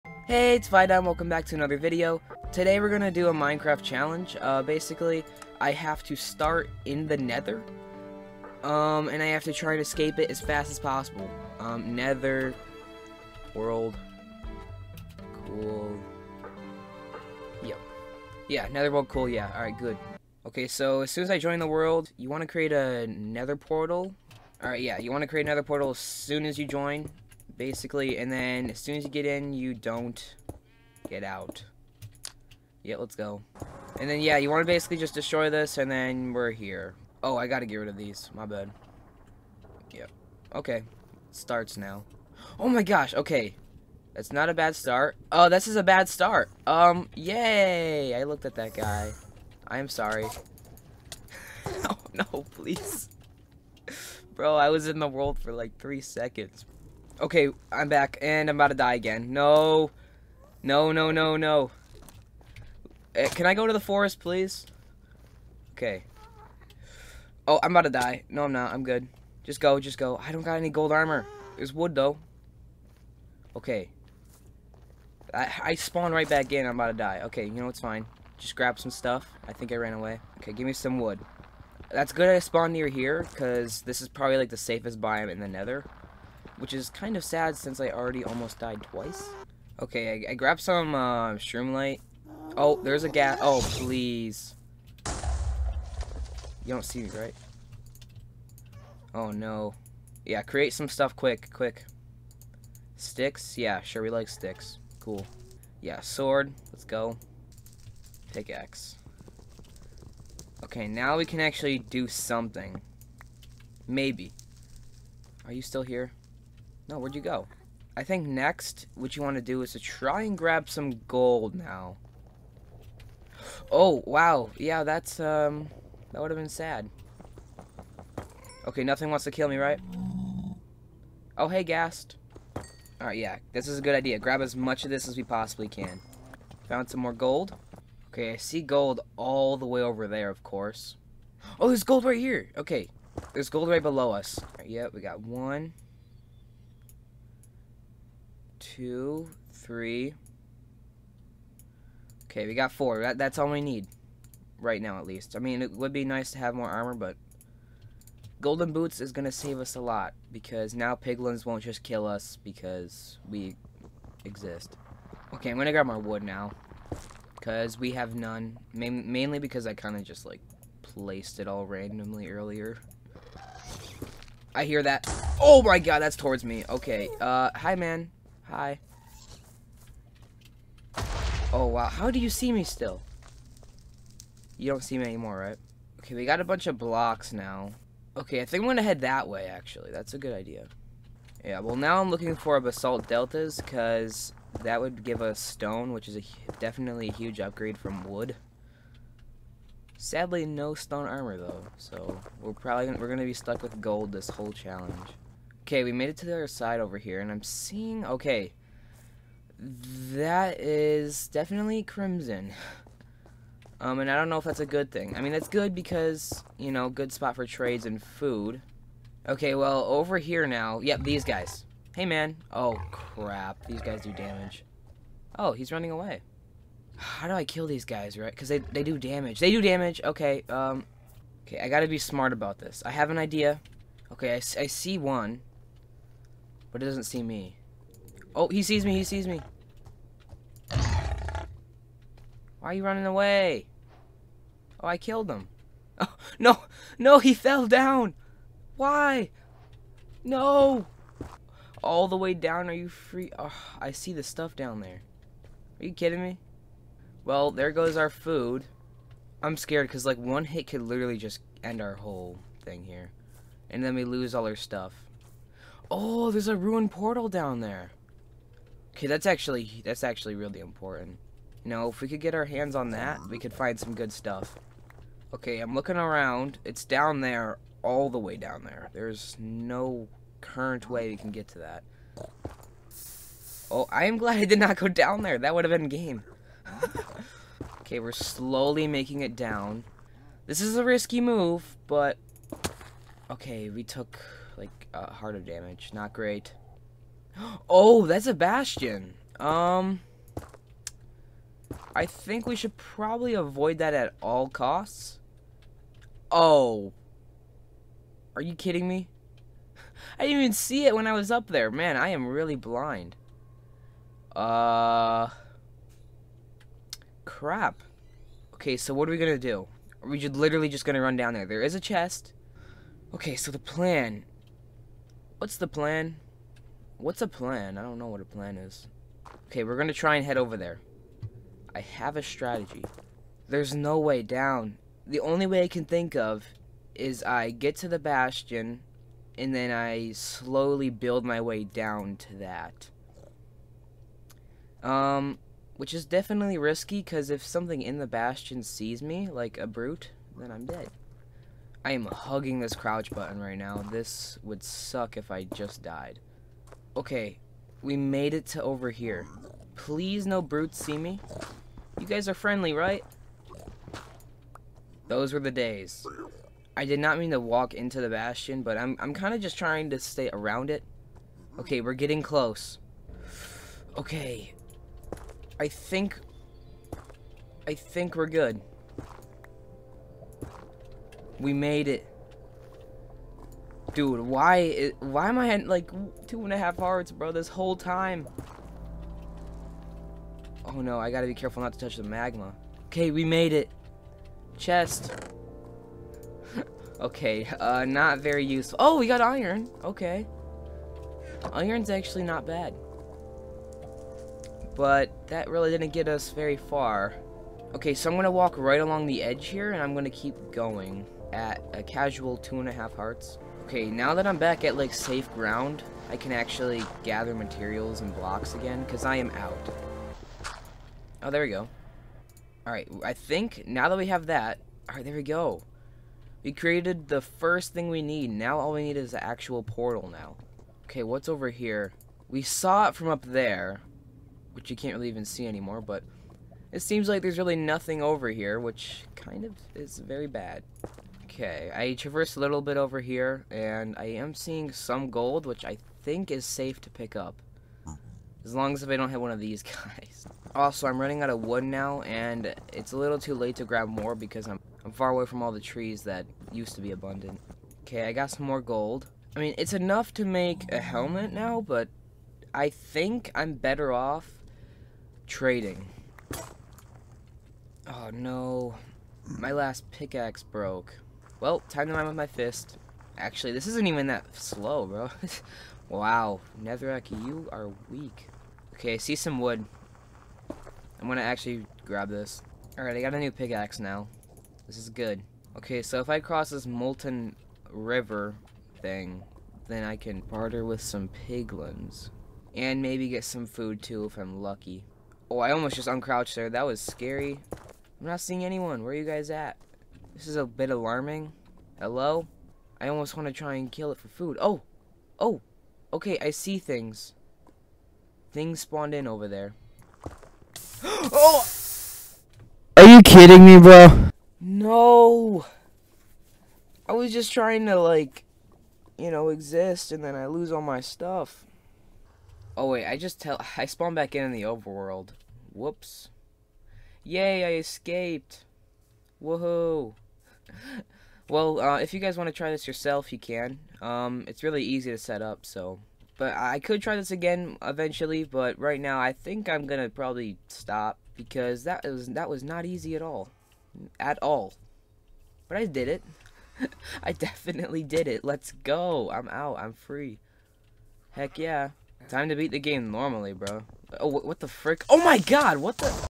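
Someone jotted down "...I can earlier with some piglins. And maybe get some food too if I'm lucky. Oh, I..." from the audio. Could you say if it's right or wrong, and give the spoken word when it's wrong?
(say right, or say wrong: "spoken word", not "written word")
wrong: "barter", not "earlier".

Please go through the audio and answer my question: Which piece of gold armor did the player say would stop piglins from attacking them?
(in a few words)
Golden Boots.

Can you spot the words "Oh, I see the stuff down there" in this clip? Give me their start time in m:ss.
4:13.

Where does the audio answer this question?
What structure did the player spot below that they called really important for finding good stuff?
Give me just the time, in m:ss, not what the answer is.
4:26.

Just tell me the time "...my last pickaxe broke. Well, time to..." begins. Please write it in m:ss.
7:49.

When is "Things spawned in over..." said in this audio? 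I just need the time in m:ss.
8:28.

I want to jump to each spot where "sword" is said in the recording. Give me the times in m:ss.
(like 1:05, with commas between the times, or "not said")
1:46.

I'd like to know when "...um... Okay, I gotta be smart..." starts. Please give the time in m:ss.
3:50.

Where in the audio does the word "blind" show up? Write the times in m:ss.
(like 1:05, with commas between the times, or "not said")
5:12.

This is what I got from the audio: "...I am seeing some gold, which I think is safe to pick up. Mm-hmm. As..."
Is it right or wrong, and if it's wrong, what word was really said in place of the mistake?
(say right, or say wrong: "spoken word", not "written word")
right.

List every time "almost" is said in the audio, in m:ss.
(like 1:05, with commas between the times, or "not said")
1:28, 8:15, 8:22.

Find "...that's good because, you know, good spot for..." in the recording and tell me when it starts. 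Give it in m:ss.
3:35.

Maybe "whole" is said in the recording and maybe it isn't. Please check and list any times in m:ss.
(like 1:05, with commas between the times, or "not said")
3:24, 4:21, 6:27.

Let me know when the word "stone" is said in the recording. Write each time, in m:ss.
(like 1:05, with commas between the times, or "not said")
3:15, 3:20.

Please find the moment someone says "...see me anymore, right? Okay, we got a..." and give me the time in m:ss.
3:04.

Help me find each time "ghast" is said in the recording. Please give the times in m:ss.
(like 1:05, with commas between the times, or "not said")
1:33, 2:11.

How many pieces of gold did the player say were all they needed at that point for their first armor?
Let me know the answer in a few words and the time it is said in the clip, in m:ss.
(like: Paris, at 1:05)
4, at 2:32.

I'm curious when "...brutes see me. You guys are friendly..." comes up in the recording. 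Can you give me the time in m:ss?
6:00.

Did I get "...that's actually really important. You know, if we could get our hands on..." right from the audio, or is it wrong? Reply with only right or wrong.
right.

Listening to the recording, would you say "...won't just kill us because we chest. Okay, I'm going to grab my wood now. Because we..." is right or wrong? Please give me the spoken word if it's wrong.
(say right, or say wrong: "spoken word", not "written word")
wrong: "exist", not "chest".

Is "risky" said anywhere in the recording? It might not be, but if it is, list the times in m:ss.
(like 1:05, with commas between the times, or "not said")
4:50, 5:46.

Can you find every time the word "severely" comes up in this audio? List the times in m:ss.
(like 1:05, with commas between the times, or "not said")
not said.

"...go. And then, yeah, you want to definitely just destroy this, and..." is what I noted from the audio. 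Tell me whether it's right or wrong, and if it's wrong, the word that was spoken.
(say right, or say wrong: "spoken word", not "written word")
wrong: "basically", not "definitely".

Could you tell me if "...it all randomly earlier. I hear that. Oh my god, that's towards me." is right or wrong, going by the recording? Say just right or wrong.
right.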